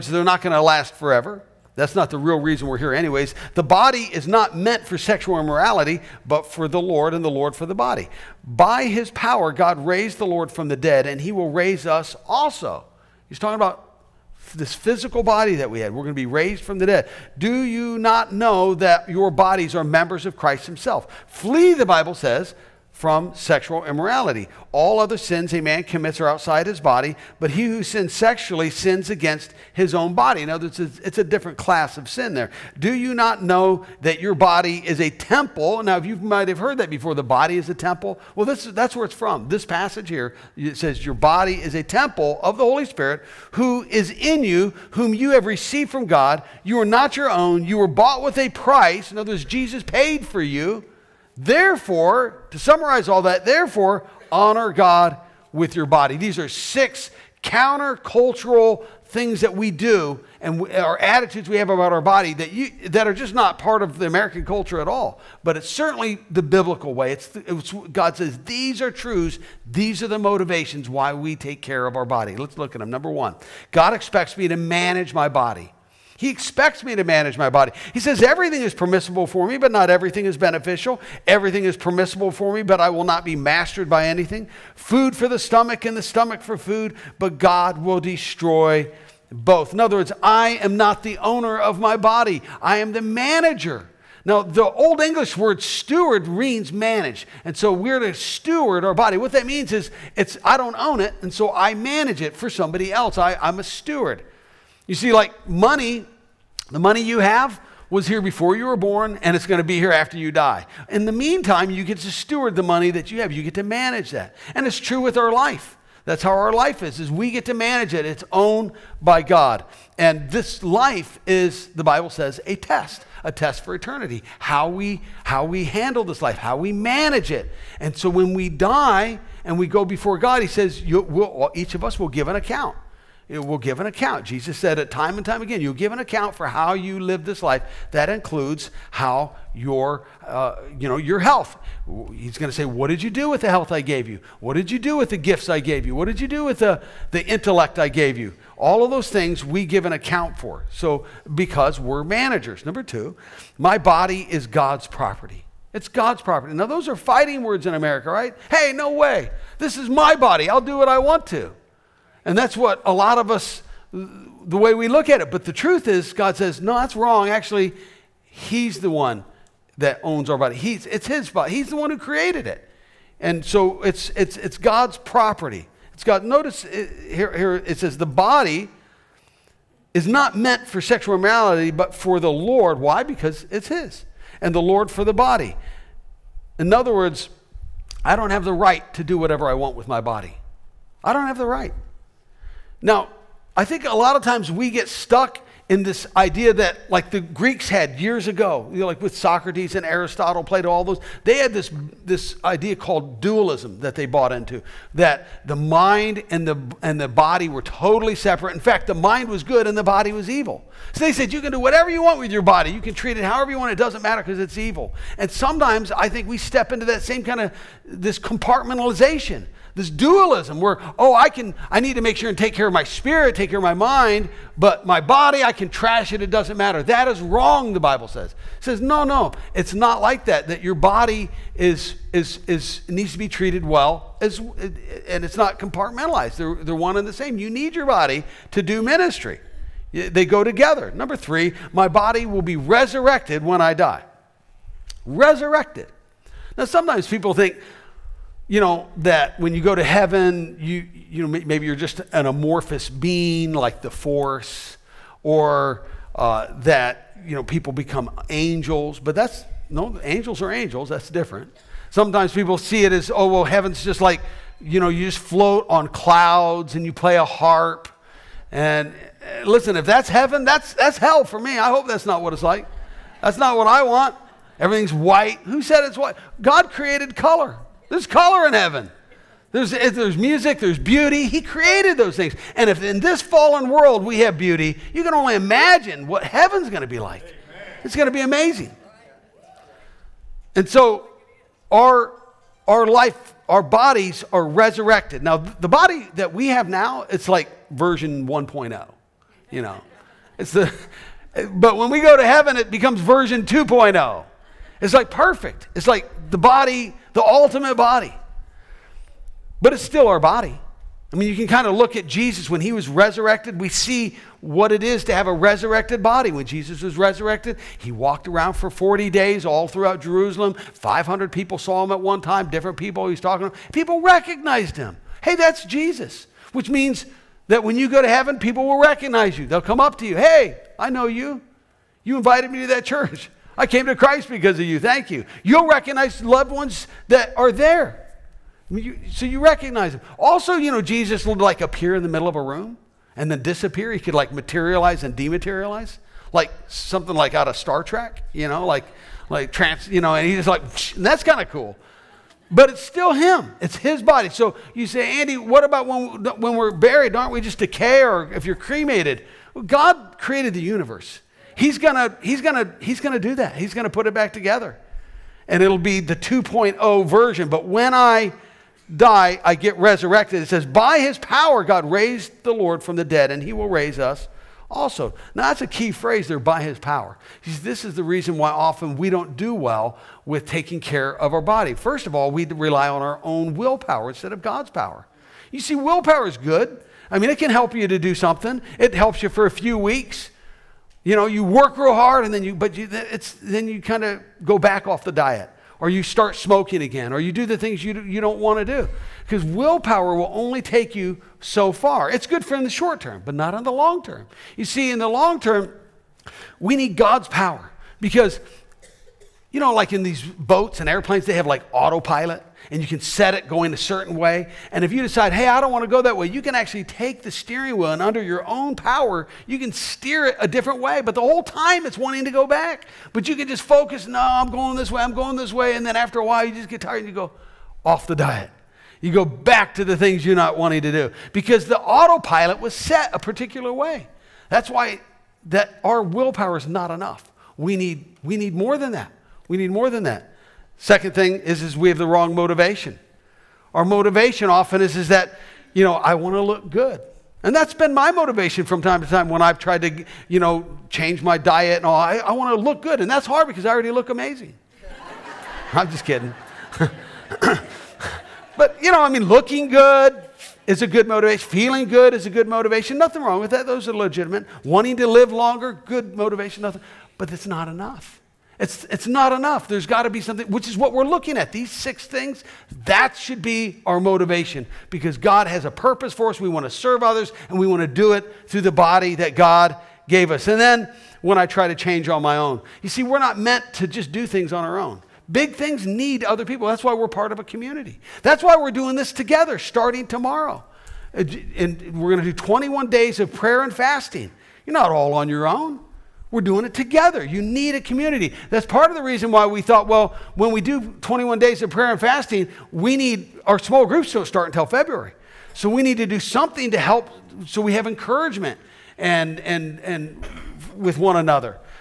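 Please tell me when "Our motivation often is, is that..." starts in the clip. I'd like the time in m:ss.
7:23.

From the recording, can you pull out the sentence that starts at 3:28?
In fact, the mind was good and the body was evil.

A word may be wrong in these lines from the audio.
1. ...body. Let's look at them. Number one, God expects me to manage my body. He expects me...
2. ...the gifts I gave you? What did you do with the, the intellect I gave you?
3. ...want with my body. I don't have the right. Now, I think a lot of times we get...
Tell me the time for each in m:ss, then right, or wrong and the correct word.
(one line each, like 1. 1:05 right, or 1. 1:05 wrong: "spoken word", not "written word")
1. 1:12 right
2. 2:25 right
3. 3:09 right.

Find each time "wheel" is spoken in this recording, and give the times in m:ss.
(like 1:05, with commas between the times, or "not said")
6:57.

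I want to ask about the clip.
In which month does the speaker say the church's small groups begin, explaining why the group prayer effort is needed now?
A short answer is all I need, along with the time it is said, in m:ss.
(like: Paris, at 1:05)
February, at 8:24.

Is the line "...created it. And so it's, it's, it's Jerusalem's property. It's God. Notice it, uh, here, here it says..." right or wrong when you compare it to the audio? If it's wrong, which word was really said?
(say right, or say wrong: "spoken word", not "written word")
wrong: "God", not "Jerusalem".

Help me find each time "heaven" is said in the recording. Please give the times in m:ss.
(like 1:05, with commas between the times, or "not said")
4:09, 4:23, 4:30, 4:38, 4:46, 5:02, 5:28.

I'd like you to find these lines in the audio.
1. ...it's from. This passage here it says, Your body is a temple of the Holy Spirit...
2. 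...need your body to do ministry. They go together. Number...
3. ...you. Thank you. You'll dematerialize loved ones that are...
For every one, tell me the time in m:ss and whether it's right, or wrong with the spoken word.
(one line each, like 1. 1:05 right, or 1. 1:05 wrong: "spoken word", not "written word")
1. 0:39 right
2. 3:57 right
3. 5:34 wrong: "recognize", not "dematerialize".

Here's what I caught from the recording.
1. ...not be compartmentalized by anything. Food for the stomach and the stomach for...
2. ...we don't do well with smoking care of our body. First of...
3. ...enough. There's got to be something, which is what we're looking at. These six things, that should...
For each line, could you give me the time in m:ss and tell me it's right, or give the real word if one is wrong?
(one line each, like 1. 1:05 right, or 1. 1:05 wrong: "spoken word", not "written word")
1. 1:23 wrong: "mastered", not "compartmentalized"
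2. 6:18 wrong: "taking", not "smoking"
3. 7:49 right.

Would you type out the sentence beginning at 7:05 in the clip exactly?
And then after a while, you just get tired and you go off the diet.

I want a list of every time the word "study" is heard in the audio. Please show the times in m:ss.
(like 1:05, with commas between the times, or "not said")
not said.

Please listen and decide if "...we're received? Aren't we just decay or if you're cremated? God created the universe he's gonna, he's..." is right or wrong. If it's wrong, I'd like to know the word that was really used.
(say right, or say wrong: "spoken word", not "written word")
wrong: "buried", not "received".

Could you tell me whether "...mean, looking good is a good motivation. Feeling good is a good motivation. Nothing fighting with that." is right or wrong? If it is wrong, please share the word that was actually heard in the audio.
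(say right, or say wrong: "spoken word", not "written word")
wrong: "wrong", not "fighting".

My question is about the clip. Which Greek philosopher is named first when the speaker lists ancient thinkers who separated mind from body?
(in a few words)
Socrates.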